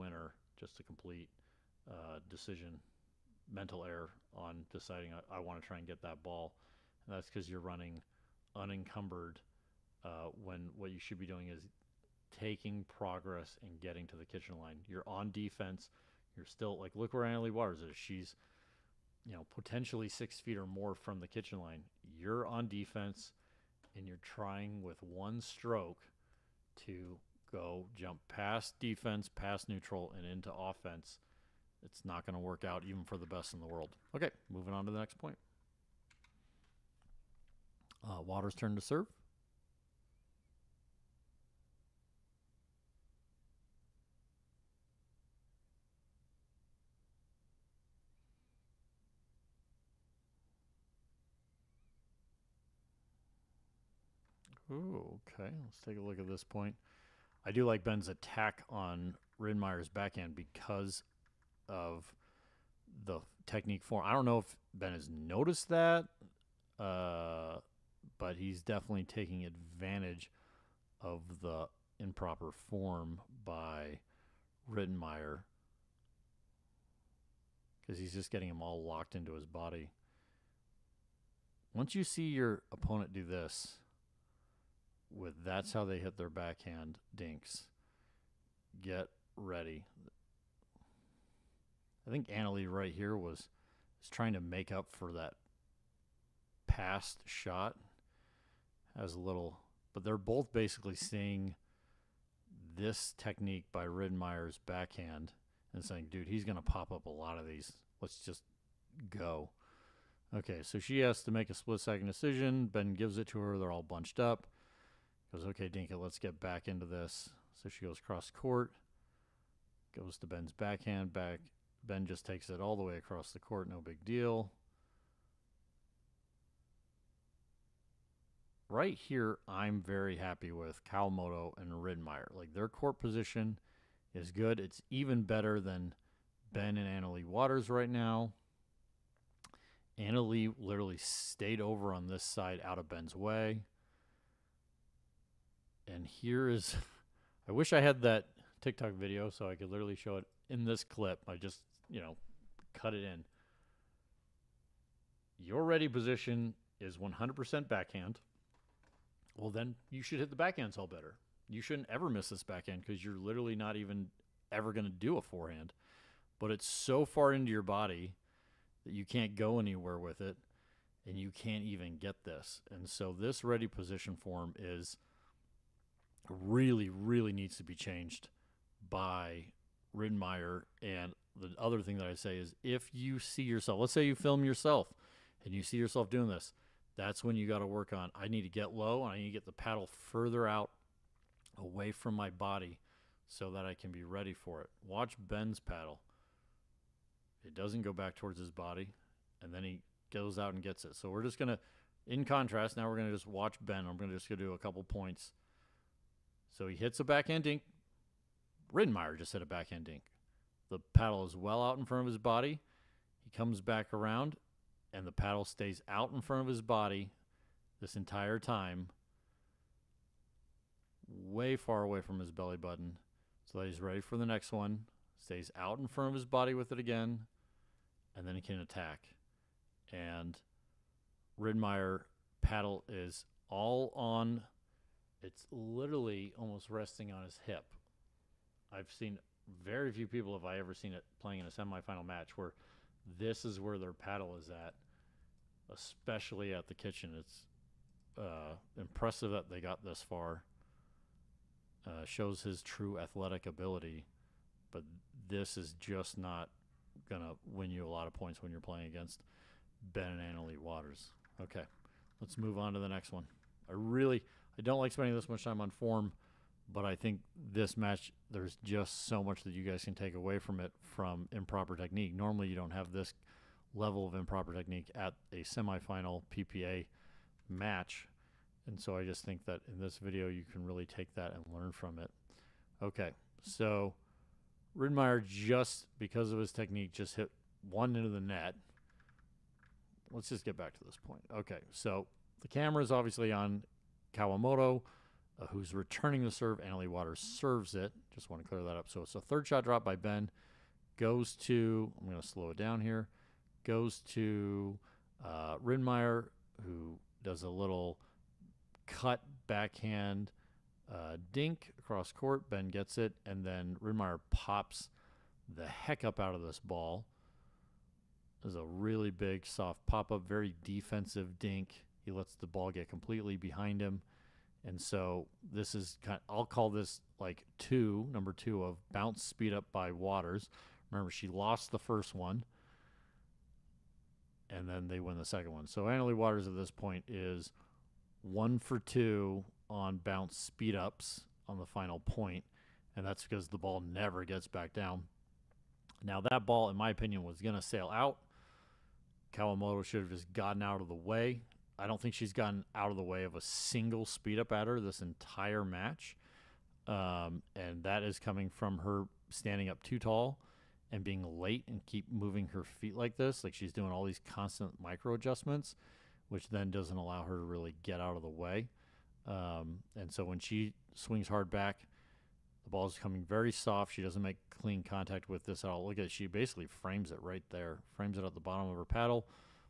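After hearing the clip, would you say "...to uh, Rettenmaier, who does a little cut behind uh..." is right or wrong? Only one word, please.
wrong.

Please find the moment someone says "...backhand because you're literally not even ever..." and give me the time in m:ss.
2:42.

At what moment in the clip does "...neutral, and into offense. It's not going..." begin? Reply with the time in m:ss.
0:29.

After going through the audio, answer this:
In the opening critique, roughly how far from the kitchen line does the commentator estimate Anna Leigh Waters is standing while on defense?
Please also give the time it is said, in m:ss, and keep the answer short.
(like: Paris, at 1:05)
6 feet or more, at 0:20.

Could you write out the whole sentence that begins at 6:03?
Like she's doing all these constant micro adjustments, which then doesn't allow her to really get out of the way.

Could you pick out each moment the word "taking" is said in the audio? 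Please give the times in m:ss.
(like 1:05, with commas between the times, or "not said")
0:12, 1:09.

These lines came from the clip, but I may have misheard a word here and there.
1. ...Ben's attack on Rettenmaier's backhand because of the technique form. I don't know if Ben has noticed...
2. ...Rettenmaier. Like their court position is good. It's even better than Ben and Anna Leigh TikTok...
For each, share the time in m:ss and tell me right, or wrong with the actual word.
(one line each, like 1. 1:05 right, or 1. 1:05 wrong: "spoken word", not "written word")
1. 0:57 right
2. 2:11 wrong: "Waters", not "TikTok".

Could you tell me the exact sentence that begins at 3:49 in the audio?
And Rettenmaier paddle is all on it's literally almost resting on his hip.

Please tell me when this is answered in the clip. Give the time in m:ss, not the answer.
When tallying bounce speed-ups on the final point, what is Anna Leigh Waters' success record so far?
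5:38.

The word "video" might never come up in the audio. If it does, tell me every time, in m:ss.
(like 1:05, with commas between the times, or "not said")
2:28, 4:39.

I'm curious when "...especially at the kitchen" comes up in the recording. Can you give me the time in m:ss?
4:05.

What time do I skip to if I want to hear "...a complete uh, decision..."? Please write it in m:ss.
0:00.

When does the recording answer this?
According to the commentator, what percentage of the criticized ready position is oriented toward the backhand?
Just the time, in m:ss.
2:36.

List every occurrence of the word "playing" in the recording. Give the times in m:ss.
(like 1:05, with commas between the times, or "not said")
4:01, 4:18.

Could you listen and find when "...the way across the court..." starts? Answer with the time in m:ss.
2:02.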